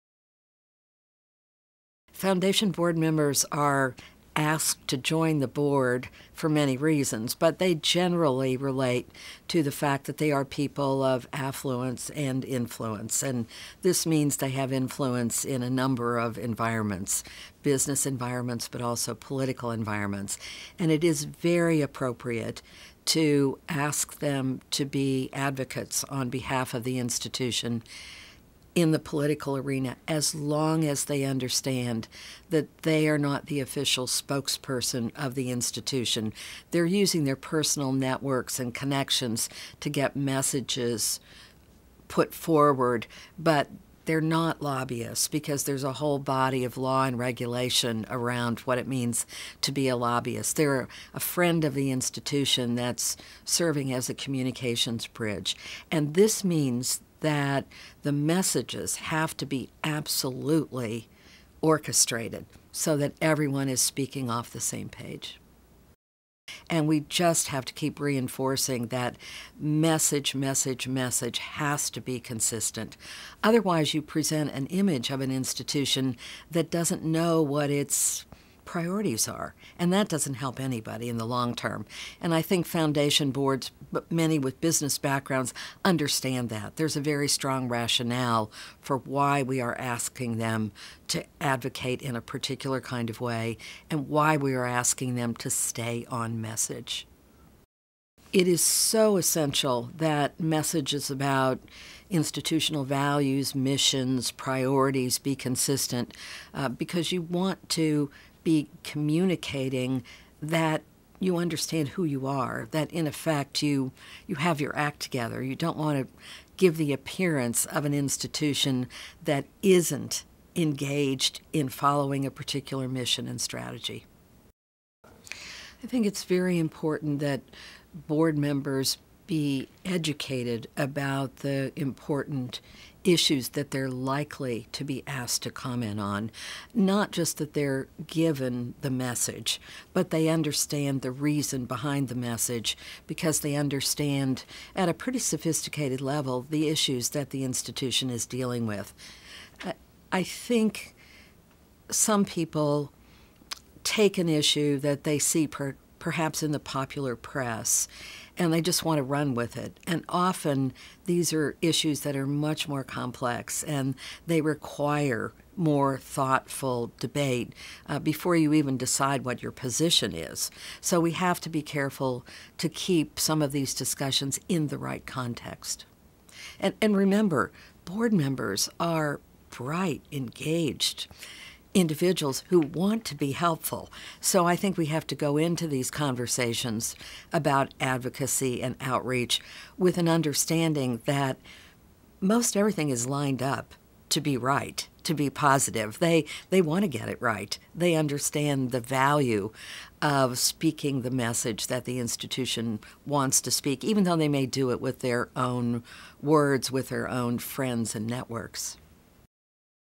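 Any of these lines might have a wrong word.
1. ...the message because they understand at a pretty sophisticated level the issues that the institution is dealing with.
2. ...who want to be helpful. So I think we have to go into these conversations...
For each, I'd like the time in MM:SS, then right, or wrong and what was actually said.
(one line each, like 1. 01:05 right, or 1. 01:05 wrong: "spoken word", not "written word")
1. 02:22 right
2. 03:02 right.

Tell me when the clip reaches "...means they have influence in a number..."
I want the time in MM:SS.
00:14.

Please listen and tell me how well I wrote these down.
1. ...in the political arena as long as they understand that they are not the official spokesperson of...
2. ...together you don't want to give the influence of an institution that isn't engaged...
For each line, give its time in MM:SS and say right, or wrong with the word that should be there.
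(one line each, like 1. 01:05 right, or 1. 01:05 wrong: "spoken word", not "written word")
1. 00:28 right
2. 01:54 wrong: "appearance", not "influence".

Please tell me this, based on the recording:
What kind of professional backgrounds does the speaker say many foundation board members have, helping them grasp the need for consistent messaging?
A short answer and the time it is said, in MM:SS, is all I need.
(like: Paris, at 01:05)
business backgrounds, at 01:24.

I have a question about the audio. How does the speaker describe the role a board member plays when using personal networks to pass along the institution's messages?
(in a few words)
communications bridge.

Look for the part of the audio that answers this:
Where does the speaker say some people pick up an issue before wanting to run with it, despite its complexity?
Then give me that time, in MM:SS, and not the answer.
02:36.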